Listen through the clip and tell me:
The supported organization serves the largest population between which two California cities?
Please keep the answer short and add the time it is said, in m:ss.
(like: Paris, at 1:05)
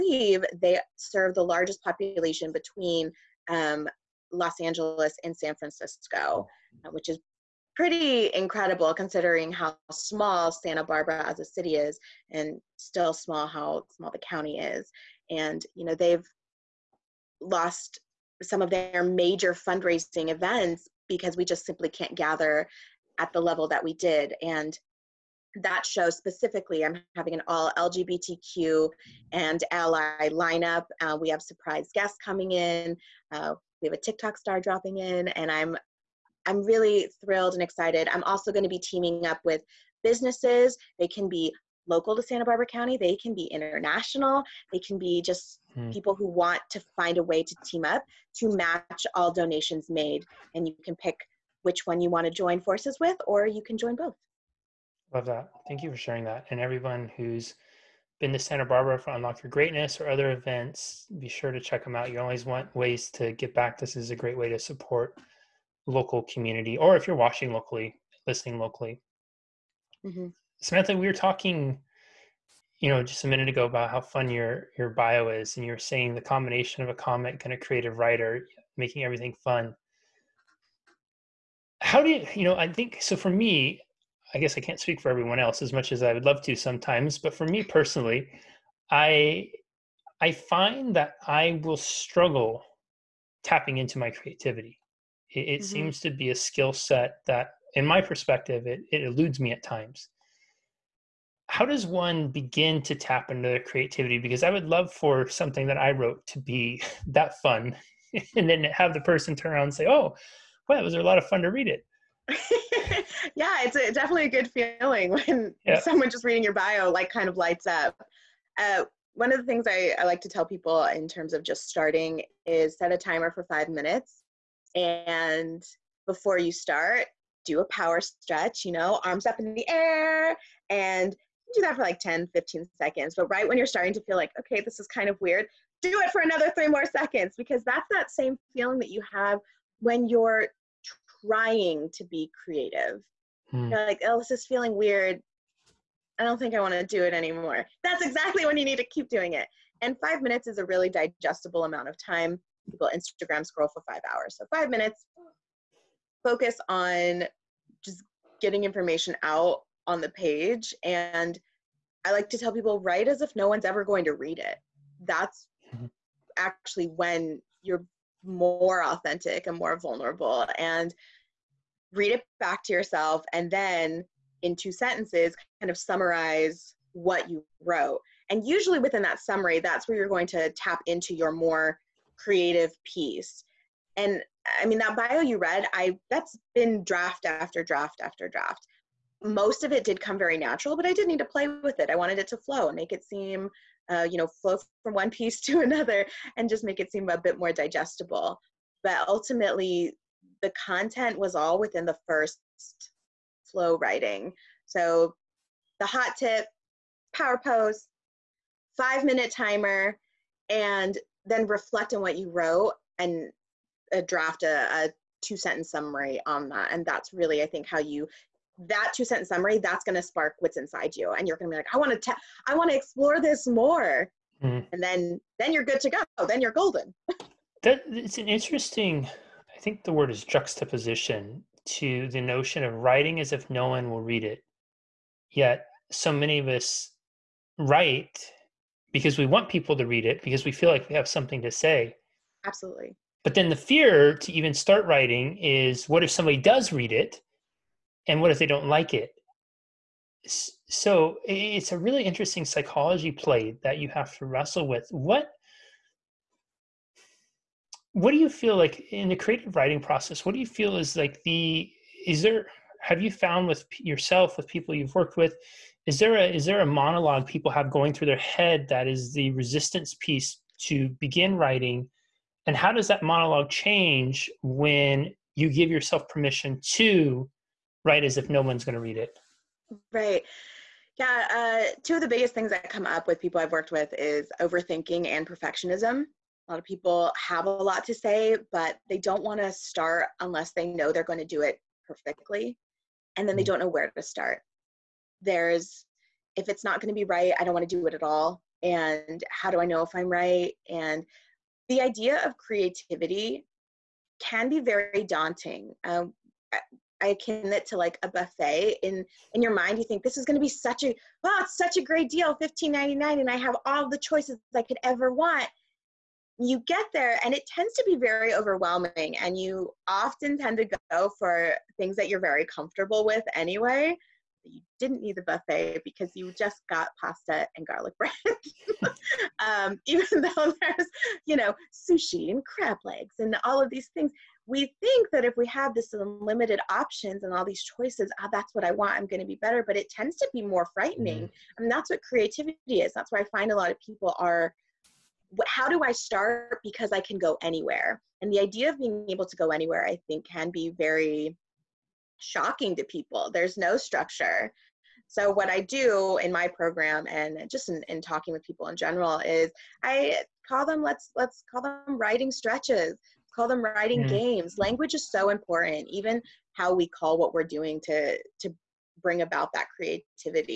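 Los Angeles and San Francisco, at 0:04.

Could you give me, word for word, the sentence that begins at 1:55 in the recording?
someone just reading your bio like kind of lights up.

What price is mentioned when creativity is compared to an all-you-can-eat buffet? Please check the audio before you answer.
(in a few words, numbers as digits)
$15.99.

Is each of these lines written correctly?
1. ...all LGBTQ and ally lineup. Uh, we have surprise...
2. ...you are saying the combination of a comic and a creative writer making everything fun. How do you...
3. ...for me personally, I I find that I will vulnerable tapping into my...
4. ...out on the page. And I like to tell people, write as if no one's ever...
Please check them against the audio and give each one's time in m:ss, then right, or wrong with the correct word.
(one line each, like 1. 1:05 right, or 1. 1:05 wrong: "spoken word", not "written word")
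1. 0:27 right
2. 1:15 right
3. 1:27 wrong: "struggle", not "vulnerable"
4. 2:39 right.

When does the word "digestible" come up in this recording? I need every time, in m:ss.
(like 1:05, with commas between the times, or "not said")
2:30, 3:17.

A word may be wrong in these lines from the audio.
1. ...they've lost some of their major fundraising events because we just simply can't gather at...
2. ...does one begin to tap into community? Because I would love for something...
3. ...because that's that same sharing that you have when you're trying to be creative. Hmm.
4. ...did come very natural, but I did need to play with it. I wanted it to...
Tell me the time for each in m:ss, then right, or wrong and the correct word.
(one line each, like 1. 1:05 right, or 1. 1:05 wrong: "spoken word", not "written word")
1. 0:15 right
2. 1:41 wrong: "creativity", not "community"
3. 2:17 wrong: "feeling", not "sharing"
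4. 3:09 right.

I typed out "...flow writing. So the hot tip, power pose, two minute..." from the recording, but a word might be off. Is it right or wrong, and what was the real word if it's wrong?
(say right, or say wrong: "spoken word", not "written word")
wrong: "five", not "two".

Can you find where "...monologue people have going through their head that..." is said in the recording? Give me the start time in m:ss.
4:26.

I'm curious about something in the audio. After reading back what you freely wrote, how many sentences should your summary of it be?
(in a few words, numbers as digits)
2.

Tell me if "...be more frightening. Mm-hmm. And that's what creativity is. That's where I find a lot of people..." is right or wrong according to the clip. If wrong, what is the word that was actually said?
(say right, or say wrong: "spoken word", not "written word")
right.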